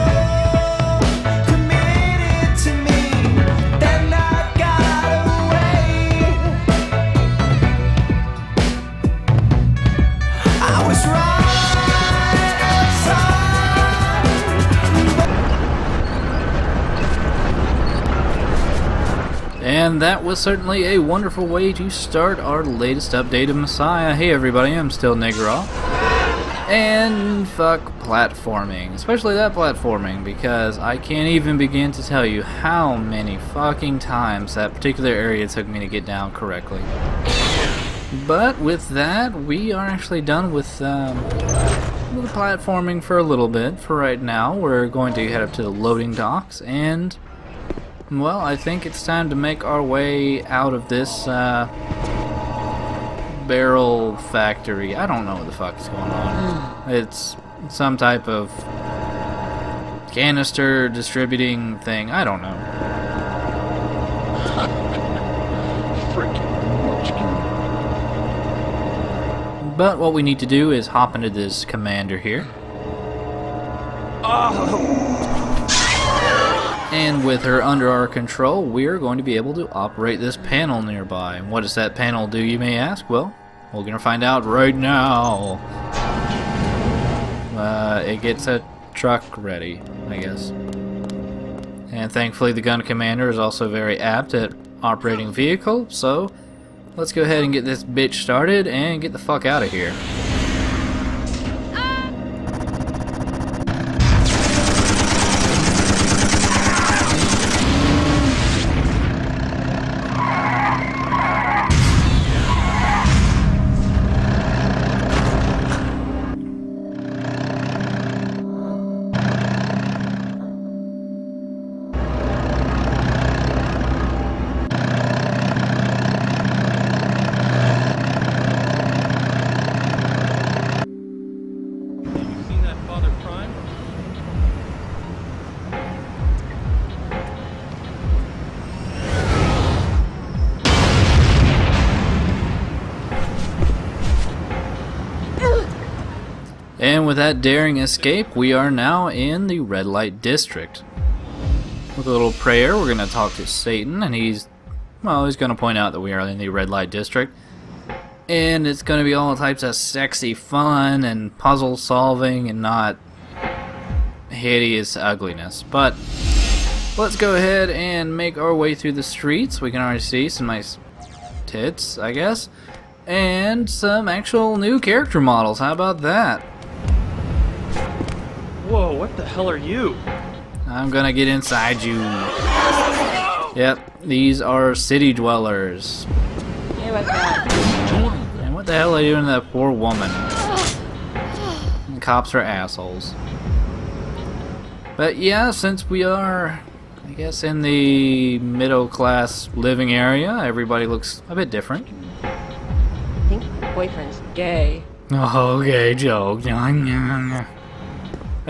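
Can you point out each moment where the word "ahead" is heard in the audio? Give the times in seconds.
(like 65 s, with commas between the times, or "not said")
97 s, 167 s.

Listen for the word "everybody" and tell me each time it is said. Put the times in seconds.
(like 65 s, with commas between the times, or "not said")
24 s, 200 s.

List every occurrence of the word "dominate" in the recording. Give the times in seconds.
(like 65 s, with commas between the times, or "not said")
not said.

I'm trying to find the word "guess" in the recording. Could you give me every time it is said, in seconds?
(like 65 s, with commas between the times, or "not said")
90 s, 172 s, 197 s.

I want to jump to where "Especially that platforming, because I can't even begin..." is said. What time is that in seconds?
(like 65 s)
28 s.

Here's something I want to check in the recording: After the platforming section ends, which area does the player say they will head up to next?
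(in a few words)
the loading docks.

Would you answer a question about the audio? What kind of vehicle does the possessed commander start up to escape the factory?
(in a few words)
a truck.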